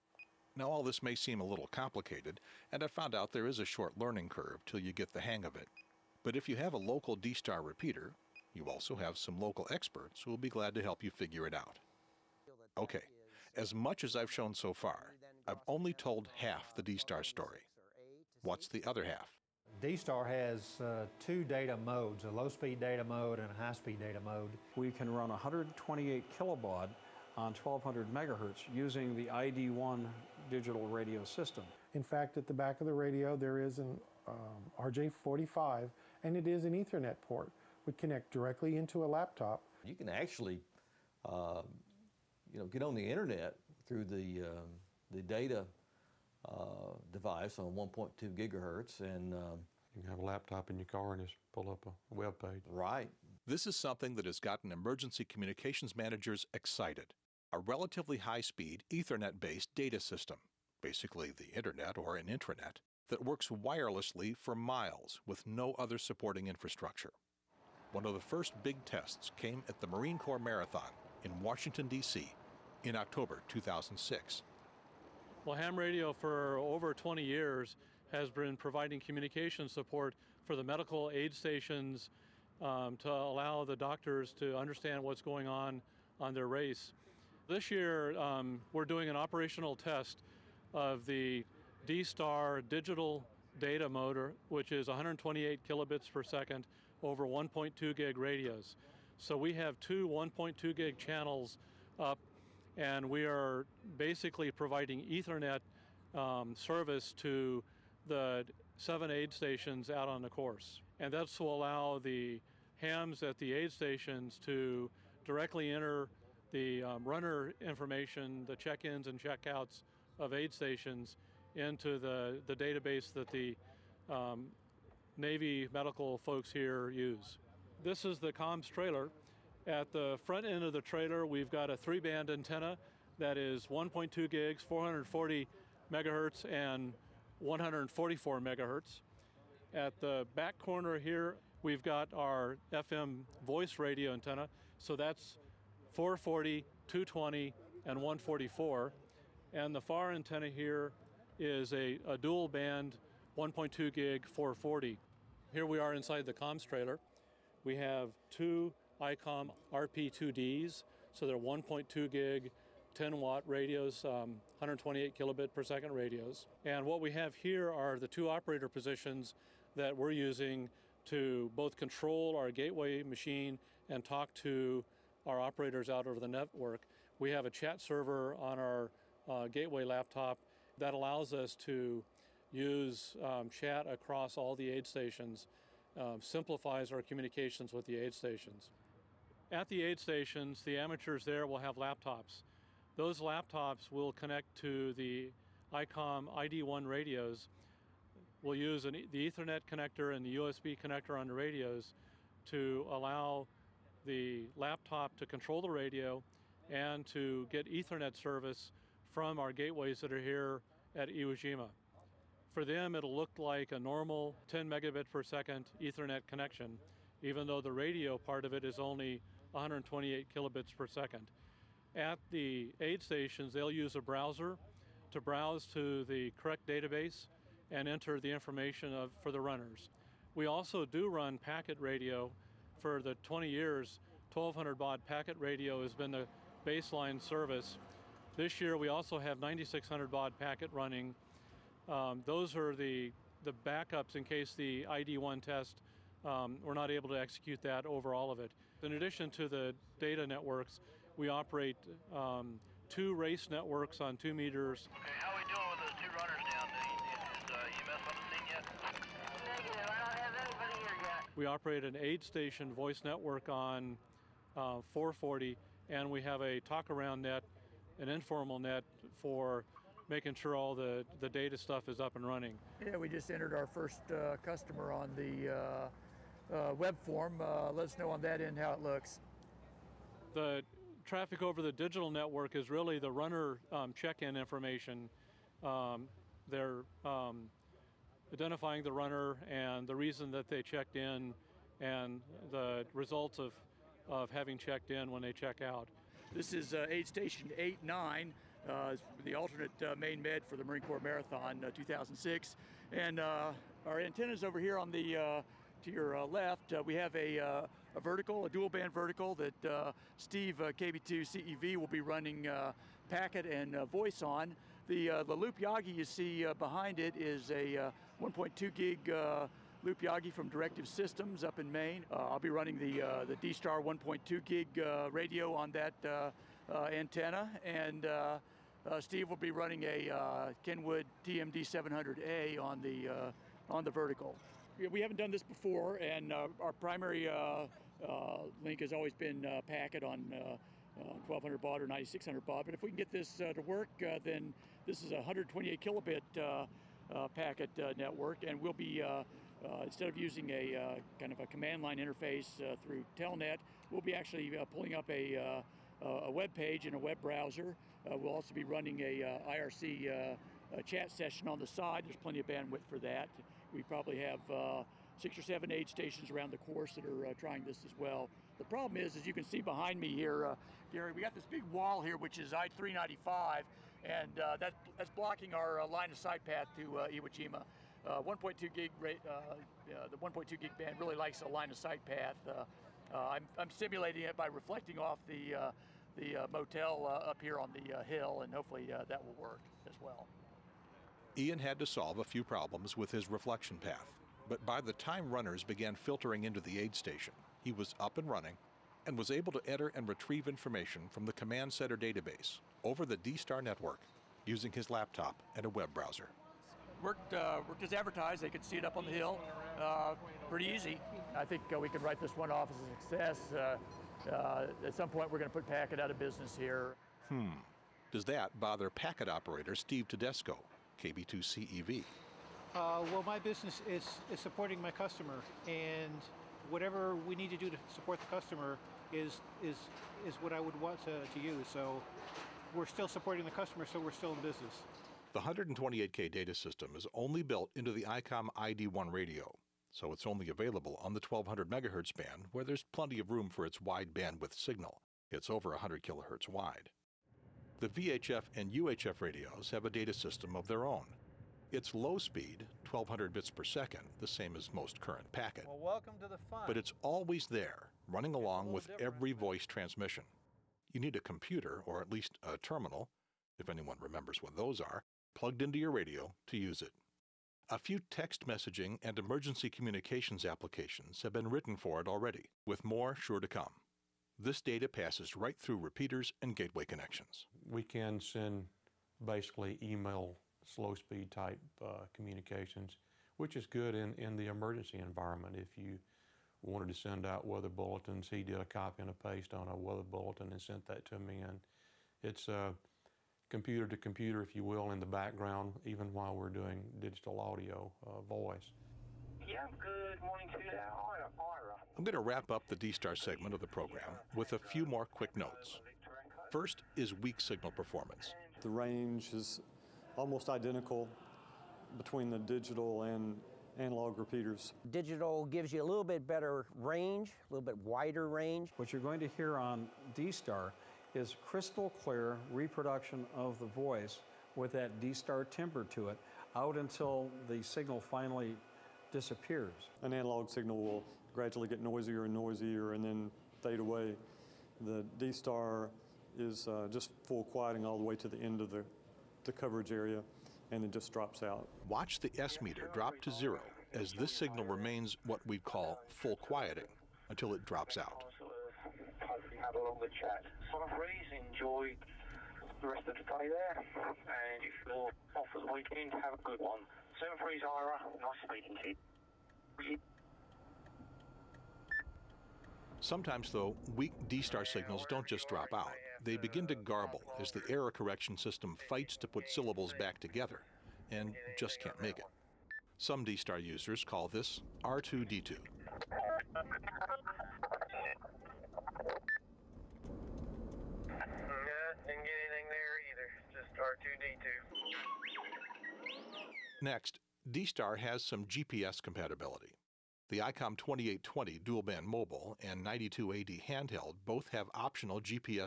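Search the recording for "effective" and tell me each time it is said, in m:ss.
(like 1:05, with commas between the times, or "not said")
not said.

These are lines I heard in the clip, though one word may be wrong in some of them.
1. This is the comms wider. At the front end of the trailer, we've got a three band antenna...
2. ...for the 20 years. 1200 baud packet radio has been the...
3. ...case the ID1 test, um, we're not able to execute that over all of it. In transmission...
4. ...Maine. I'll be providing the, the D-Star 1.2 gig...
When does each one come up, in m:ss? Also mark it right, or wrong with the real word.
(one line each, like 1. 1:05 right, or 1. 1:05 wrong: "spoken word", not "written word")
1. 2:07 wrong: "trailer", not "wider"
2. 3:52 right
3. 4:04 wrong: "addition", not "transmission"
4. 5:21 wrong: "running", not "providing".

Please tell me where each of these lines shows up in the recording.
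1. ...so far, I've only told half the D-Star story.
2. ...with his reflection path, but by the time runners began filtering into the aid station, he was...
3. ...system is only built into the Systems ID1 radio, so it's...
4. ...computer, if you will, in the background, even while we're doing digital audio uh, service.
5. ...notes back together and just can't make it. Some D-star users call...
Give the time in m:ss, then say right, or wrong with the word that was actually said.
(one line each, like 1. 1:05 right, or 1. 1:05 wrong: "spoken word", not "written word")
1. 0:14 right
2. 6:32 right
3. 7:16 wrong: "ICOM", not "Systems"
4. 8:13 wrong: "voice", not "service"
5. 9:29 wrong: "syllables", not "notes".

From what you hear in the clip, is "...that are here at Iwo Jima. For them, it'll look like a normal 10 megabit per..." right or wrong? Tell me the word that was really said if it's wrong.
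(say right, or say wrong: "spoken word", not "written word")
right.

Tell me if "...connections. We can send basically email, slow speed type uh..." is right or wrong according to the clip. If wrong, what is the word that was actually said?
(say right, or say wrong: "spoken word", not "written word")
right.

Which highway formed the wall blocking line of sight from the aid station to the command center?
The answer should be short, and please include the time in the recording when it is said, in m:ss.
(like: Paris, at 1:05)
I-395, at 6:12.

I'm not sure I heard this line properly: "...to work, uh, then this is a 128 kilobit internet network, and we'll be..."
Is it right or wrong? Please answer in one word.
wrong.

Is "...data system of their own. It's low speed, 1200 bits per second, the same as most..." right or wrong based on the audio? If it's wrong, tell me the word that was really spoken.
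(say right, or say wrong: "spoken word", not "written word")
right.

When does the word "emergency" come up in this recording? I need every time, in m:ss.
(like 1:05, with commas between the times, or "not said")
0:54, 7:49, 8:04.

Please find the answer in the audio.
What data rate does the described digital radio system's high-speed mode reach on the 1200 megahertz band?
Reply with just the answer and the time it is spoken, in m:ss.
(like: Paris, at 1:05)
128 kilobaud, at 0:25.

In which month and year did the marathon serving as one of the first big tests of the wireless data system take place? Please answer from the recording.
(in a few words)
October 2006.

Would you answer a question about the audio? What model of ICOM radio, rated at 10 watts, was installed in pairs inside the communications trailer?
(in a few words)
RP2D.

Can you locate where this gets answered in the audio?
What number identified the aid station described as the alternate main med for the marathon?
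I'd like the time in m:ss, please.
4:57.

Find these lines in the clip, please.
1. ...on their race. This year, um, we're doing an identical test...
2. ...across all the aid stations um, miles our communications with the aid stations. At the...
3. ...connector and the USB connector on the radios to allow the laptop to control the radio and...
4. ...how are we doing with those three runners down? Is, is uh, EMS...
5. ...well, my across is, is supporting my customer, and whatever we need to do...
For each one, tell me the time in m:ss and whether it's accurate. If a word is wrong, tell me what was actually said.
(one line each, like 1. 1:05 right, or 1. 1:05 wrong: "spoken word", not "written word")
1. 1:26 wrong: "operational", not "identical"
2. 3:03 wrong: "simplifies", not "miles"
3. 3:19 right
4. 4:14 wrong: "two", not "three"
5. 7:03 wrong: "business", not "across".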